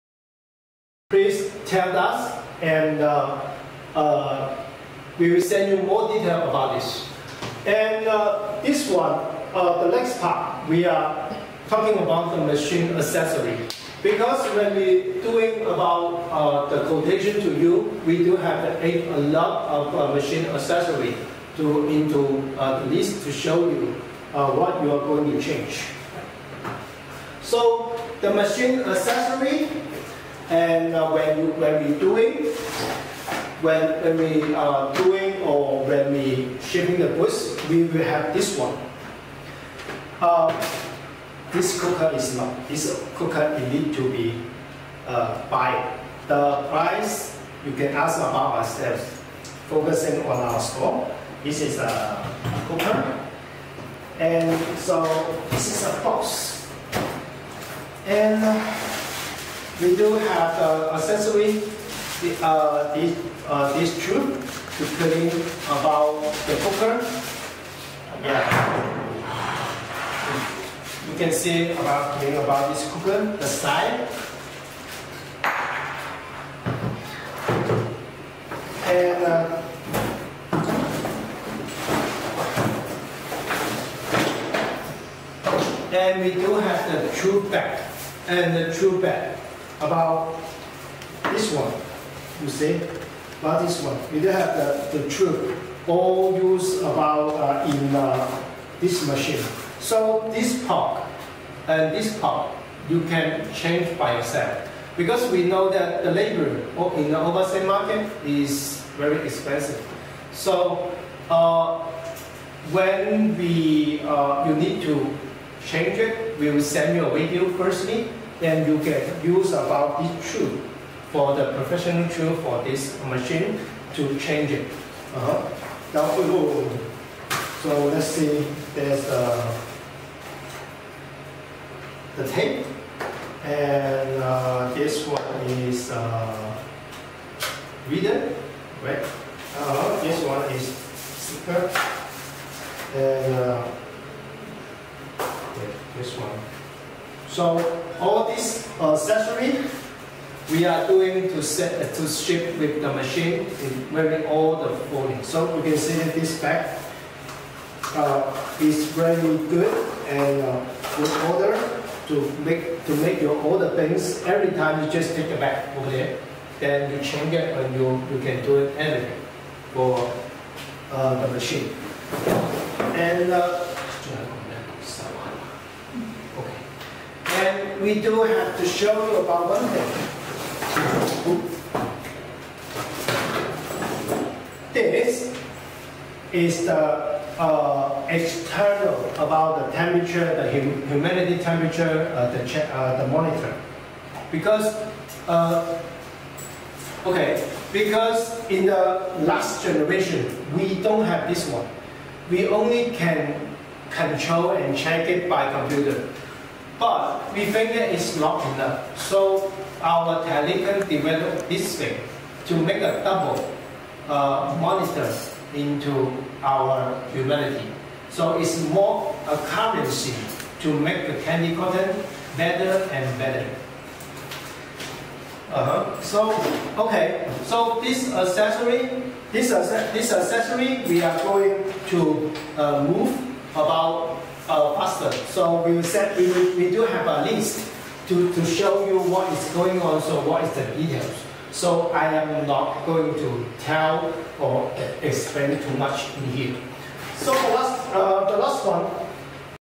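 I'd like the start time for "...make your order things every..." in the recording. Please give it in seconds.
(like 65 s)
162 s.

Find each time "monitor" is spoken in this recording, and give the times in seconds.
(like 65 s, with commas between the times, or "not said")
193 s, 214 s.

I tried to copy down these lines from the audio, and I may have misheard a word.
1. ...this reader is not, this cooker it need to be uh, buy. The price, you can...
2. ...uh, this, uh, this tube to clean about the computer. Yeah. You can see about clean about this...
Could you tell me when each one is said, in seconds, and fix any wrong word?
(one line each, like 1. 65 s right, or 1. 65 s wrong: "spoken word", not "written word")
1. 41 s wrong: "cooker", not "reader"
2. 62 s wrong: "cooker", not "computer".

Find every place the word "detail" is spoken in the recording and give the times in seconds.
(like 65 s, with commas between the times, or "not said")
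6 s, 240 s.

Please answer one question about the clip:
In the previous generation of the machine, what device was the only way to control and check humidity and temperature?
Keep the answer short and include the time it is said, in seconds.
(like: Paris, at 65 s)
computer, at 204 s.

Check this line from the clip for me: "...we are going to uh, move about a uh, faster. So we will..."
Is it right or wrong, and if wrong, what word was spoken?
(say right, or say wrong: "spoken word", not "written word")
right.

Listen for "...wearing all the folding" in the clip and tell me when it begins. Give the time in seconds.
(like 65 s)
153 s.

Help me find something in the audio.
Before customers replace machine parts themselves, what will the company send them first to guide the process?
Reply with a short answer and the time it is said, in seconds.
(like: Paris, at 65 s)
a video, at 116 s.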